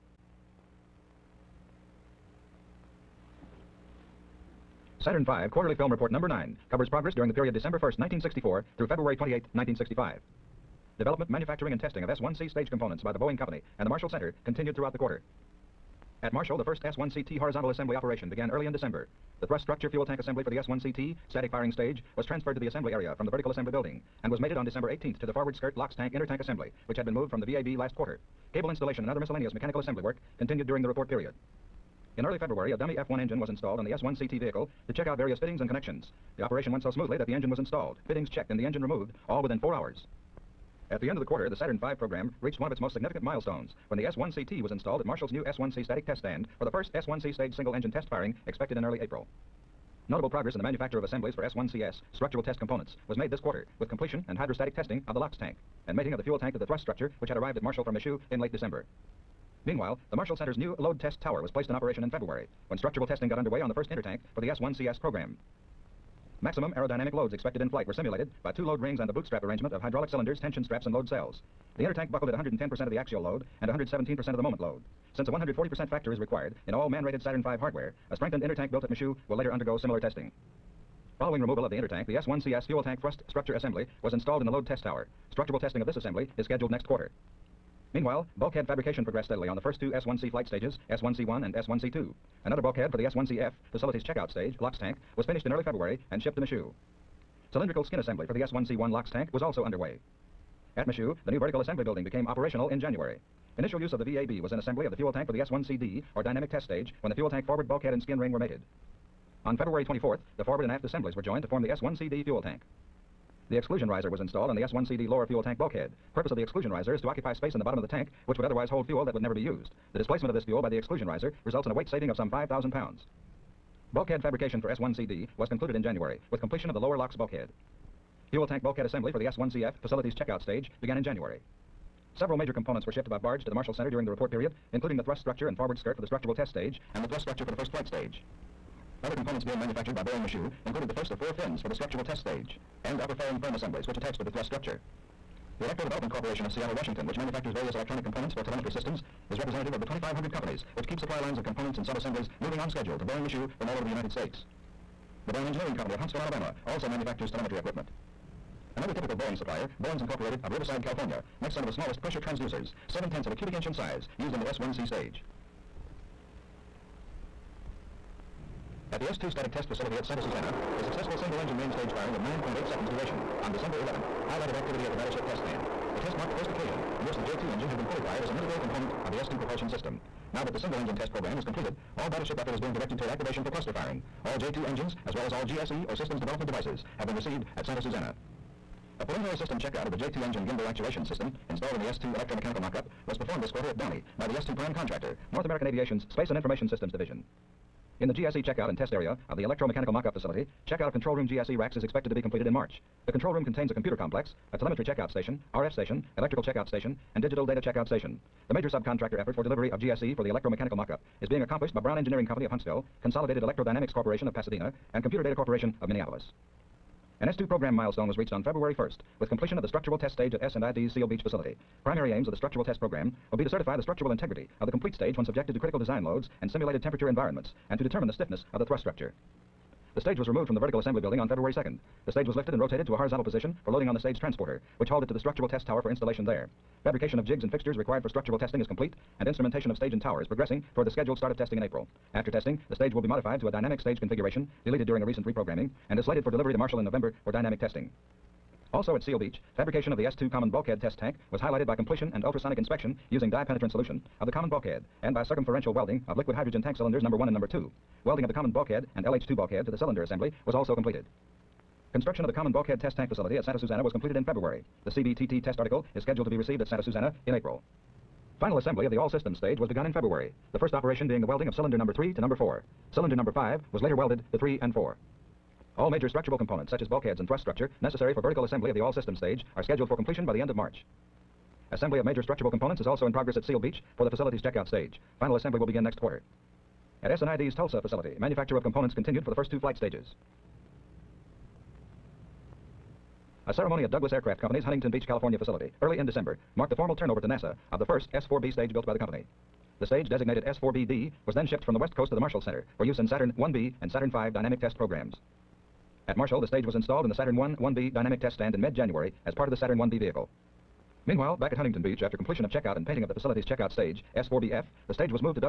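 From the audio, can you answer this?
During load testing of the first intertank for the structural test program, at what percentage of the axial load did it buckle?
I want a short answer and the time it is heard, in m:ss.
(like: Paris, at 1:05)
110%, at 1:12.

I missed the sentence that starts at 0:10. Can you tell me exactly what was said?
Development, manufacturing, and testing of S-1C stage components by the Boeing Company and the Marshall Center continued throughout the quarter.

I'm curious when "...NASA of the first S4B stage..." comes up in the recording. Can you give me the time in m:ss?
4:57.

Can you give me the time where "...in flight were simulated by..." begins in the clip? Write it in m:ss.
1:07.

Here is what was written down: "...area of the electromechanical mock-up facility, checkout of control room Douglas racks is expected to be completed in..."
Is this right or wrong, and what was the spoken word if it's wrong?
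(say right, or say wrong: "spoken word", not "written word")
wrong: "GSE", not "Douglas".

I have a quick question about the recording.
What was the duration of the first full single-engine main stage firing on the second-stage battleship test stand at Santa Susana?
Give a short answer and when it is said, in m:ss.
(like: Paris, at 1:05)
9.8 seconds, at 2:52.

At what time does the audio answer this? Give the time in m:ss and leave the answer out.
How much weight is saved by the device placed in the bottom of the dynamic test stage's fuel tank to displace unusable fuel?
2:02.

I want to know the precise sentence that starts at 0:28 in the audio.
Cable installation and other miscellaneous mechanical assembly work continued during the report period.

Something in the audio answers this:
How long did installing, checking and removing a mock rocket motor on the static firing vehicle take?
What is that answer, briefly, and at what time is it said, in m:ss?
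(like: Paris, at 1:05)
4 hours, at 0:39.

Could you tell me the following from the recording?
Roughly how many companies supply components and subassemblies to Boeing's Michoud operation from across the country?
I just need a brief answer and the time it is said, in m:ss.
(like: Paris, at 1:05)
2,500, at 2:29.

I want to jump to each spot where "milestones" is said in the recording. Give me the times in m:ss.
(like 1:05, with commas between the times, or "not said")
0:43, 3:37.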